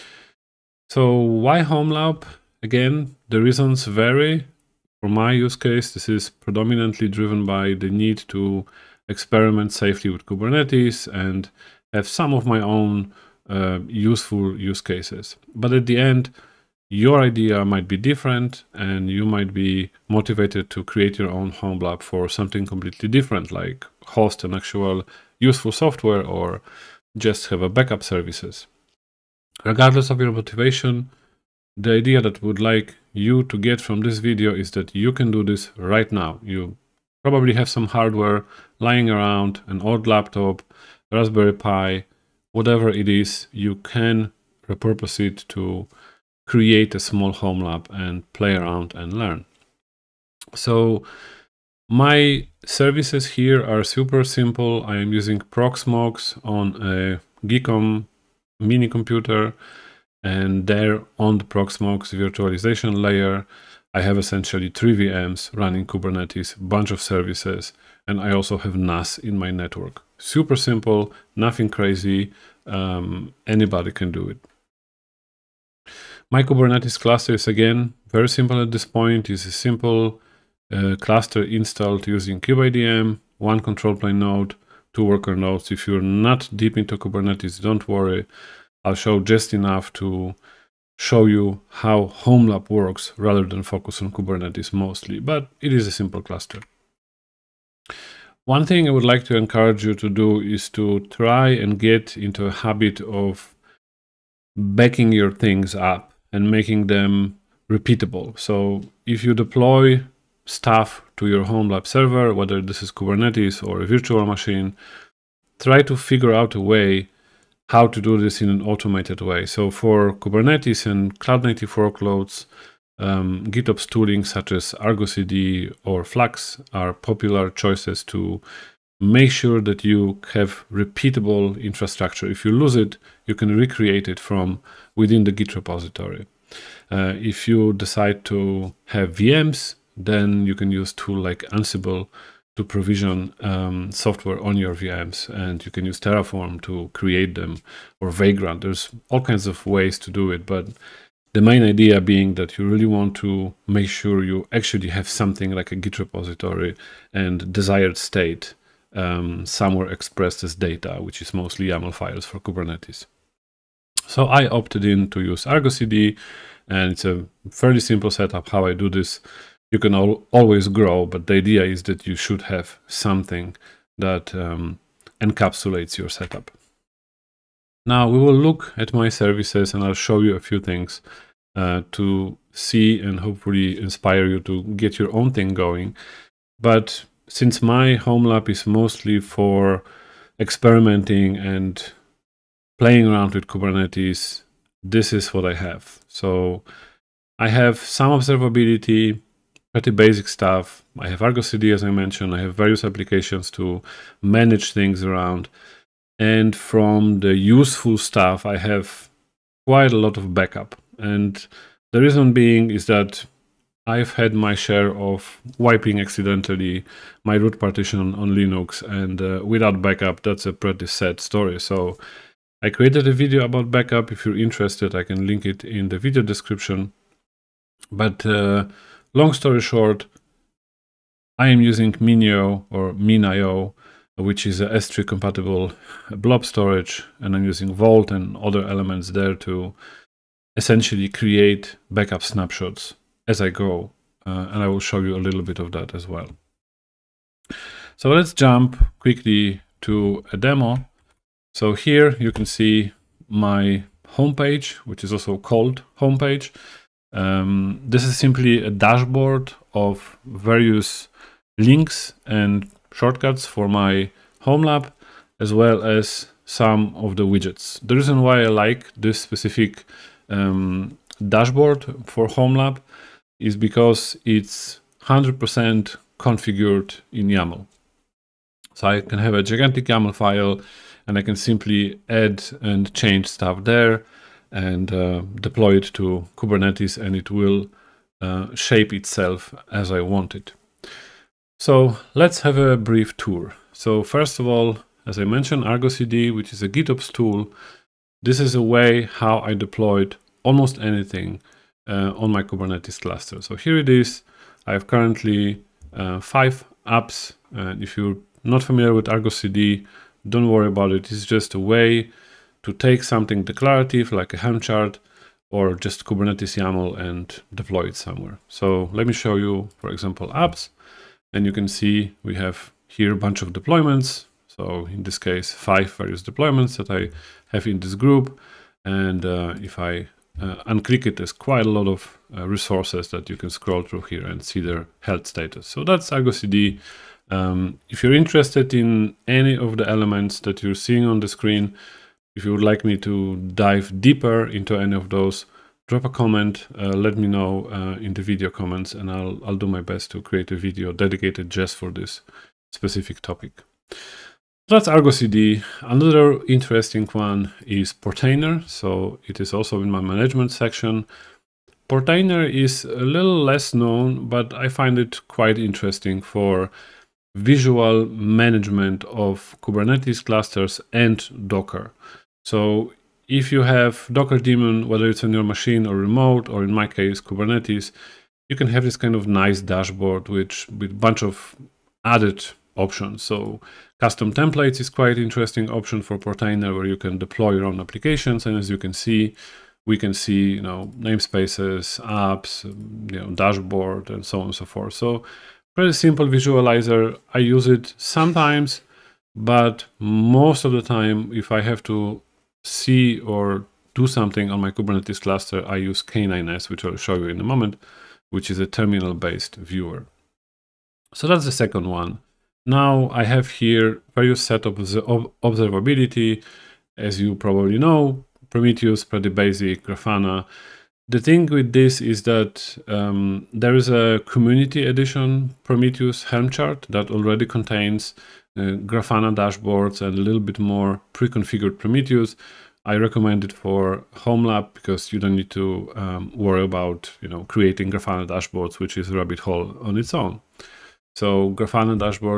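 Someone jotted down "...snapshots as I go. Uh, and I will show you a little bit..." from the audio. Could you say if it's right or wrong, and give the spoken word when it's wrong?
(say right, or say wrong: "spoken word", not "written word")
right.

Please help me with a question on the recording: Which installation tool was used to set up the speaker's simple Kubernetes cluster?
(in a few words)
kubeadm.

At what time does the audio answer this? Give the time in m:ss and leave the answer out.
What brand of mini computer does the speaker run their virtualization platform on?
0:57.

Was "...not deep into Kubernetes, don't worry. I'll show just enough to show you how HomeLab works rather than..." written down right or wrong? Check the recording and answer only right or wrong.
right.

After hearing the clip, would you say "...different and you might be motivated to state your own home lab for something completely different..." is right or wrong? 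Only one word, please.
wrong.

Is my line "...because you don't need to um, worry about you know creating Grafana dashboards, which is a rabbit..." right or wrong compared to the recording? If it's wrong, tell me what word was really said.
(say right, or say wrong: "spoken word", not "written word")
right.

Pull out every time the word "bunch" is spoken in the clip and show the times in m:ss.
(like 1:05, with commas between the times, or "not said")
1:06, 5:23, 6:21.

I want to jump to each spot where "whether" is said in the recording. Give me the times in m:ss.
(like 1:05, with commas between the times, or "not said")
1:52, 6:14.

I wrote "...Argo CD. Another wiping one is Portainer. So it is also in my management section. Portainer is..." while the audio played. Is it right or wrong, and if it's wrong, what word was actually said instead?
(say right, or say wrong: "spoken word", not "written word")
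wrong: "interesting", not "wiping".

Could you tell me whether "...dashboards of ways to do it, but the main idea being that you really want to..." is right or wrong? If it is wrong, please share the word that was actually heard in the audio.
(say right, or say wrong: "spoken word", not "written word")
wrong: "kinds", not "dashboards".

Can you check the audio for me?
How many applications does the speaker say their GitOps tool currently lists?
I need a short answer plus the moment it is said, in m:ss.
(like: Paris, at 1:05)
5, at 5:06.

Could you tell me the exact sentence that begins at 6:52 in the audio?
Now I have here various set of observability, as you probably know, Prometheus, pretty basic, Grafana.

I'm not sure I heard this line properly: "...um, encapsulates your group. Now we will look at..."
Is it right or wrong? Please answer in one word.
wrong.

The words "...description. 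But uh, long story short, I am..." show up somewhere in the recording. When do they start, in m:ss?
3:46.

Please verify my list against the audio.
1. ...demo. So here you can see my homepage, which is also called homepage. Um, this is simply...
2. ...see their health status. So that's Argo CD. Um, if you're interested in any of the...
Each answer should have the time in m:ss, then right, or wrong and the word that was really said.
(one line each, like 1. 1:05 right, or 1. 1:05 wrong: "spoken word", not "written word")
1. 4:10 right
2. 5:34 right.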